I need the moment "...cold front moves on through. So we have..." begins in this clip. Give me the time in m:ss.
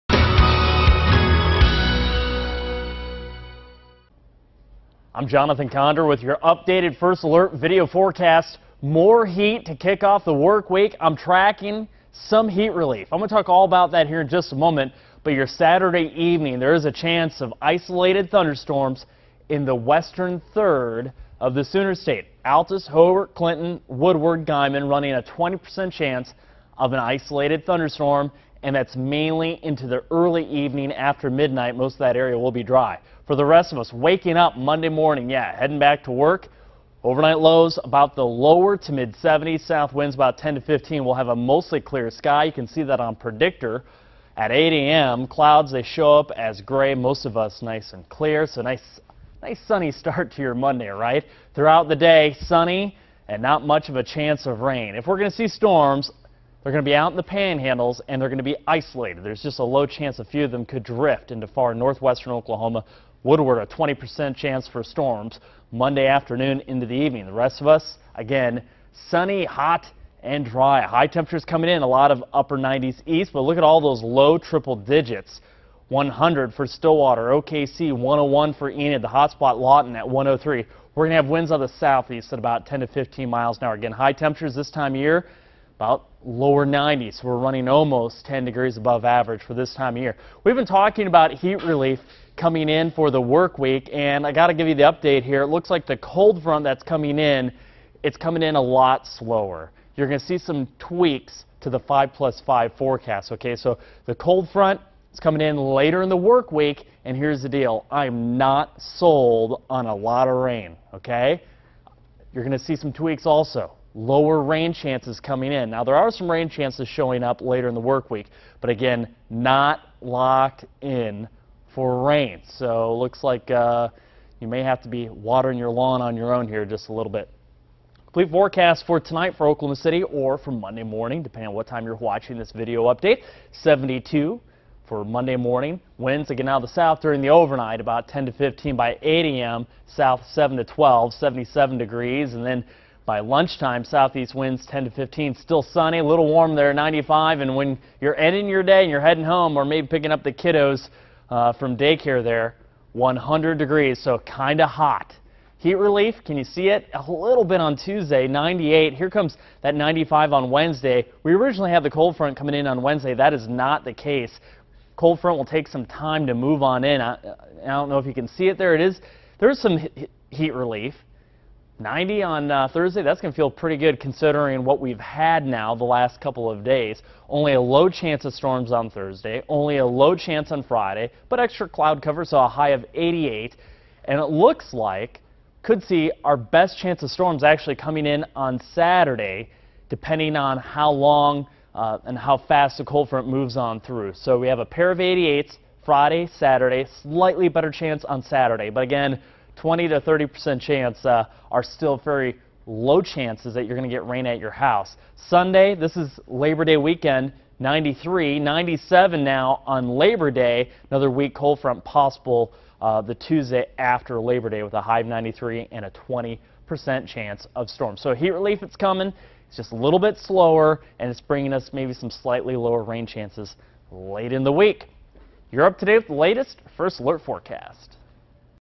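3:12.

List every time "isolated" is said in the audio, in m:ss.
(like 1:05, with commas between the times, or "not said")
0:17, 0:26, 0:58.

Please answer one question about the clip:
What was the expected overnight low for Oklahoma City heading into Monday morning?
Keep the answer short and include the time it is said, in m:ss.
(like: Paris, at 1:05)
72, at 2:13.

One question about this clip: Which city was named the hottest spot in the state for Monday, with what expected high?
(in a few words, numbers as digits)
Lawton, 103.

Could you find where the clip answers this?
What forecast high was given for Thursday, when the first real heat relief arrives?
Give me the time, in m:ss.
2:51.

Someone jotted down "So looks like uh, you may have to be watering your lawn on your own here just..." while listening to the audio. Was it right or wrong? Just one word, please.
right.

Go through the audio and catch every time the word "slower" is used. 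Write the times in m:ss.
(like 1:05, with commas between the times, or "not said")
1:39, 3:40.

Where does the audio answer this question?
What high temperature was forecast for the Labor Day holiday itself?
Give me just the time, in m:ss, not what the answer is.
3:28.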